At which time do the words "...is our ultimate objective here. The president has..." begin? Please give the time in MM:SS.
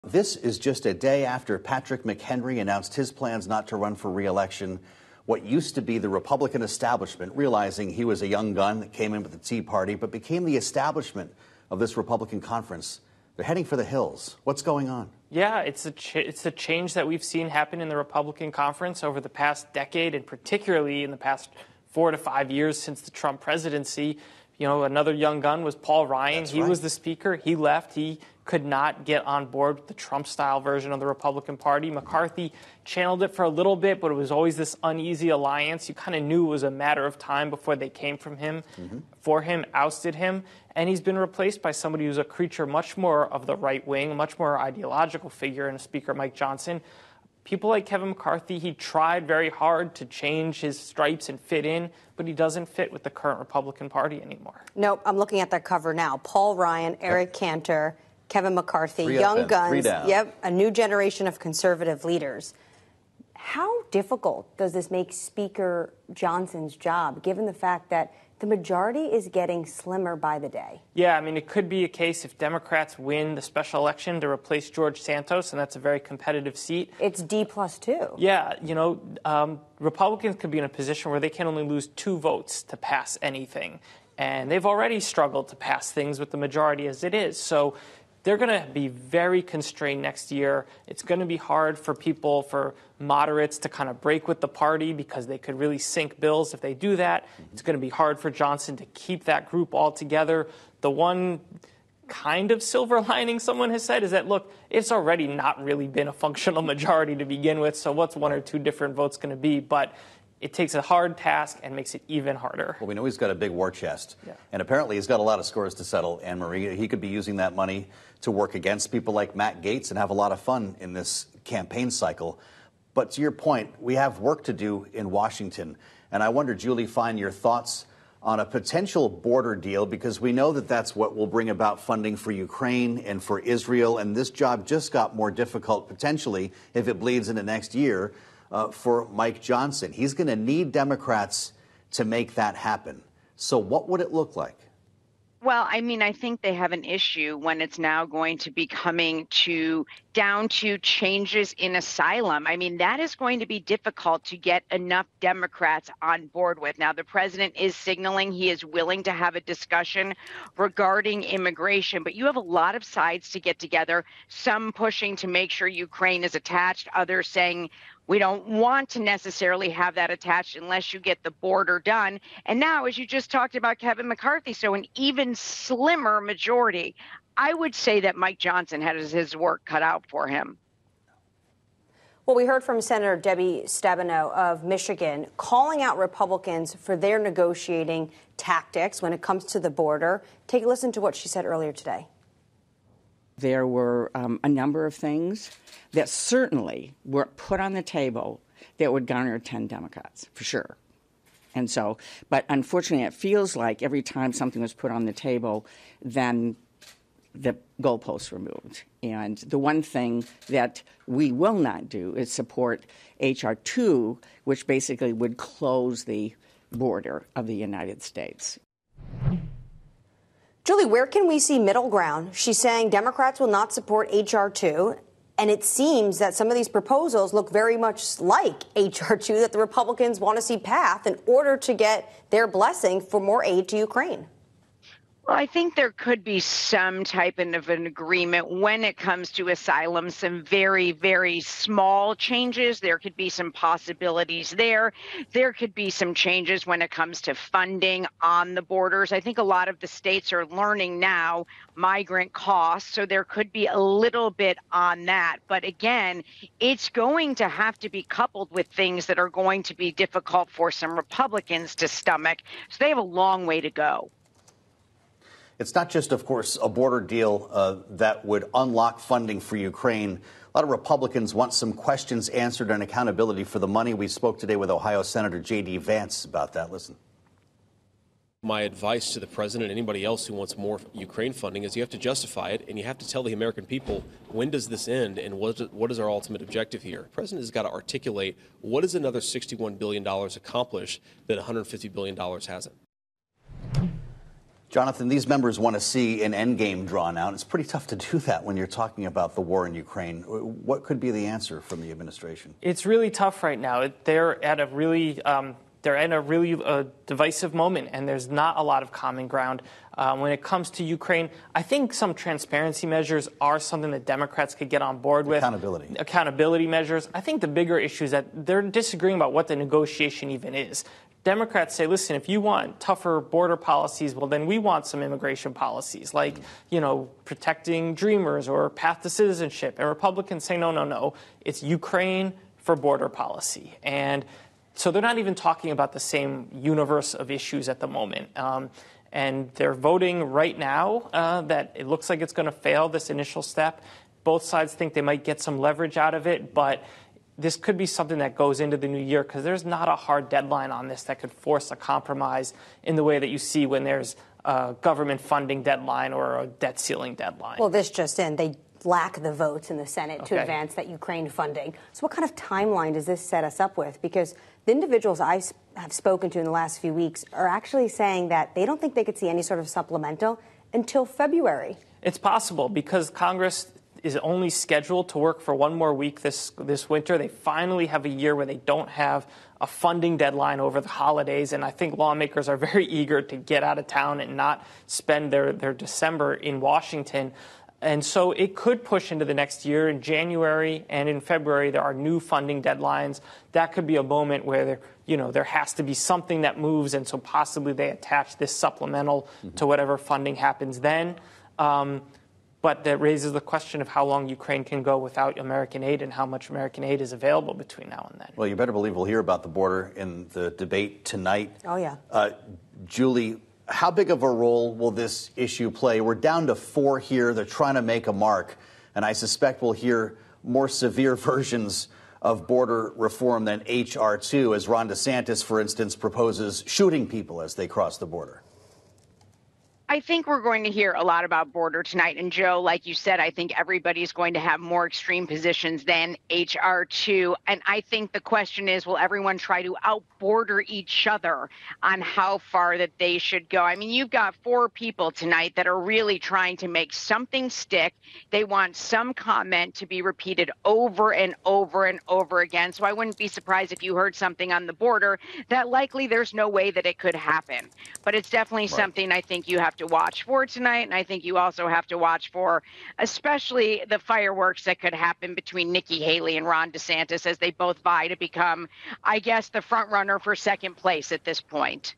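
04:45.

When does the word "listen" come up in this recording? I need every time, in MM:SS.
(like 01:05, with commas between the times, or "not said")
03:10, 04:36, 05:21.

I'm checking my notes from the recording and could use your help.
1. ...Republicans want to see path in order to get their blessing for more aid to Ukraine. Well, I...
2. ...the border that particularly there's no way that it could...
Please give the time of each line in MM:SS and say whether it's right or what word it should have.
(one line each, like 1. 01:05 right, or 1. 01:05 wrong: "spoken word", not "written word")
1. 03:49 right
2. 07:34 wrong: "likely", not "particularly".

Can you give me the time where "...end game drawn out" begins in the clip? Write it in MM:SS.
04:56.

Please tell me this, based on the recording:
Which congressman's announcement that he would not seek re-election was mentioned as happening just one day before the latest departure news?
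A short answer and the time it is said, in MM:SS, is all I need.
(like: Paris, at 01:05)
Patrick McHenry, at 00:01.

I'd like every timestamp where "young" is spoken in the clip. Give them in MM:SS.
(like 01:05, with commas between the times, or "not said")
00:08, 00:25, 00:59.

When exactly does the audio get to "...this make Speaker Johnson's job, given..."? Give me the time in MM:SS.
01:04.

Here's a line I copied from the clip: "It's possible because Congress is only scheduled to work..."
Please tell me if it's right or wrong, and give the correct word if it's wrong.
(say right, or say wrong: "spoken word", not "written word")
right.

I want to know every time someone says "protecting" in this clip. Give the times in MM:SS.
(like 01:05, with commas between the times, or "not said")
05:27.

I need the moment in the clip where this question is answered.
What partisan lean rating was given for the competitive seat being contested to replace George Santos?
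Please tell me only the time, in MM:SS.
01:17.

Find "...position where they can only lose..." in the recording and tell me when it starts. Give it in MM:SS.
01:20.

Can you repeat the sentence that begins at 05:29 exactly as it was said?
And Republicans say, no, no, no, it's Ukraine for border policy.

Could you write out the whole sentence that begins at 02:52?
And now, as you just talked about Kevin McCarthy, so an even slimmer majority.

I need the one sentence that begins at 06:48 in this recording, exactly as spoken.
Well, you better believe we'll hear about the border in the debate tonight.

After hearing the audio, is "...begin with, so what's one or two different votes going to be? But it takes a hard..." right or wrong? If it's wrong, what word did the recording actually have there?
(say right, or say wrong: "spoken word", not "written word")
right.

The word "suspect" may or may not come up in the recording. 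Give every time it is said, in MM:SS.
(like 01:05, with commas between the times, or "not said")
06:59.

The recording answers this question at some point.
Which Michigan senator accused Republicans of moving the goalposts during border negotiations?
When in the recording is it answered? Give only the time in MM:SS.
03:03.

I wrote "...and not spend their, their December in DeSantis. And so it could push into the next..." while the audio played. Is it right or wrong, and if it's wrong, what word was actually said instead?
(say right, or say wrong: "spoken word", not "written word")
wrong: "Washington", not "DeSantis".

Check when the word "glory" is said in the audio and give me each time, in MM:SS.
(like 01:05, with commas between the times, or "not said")
not said.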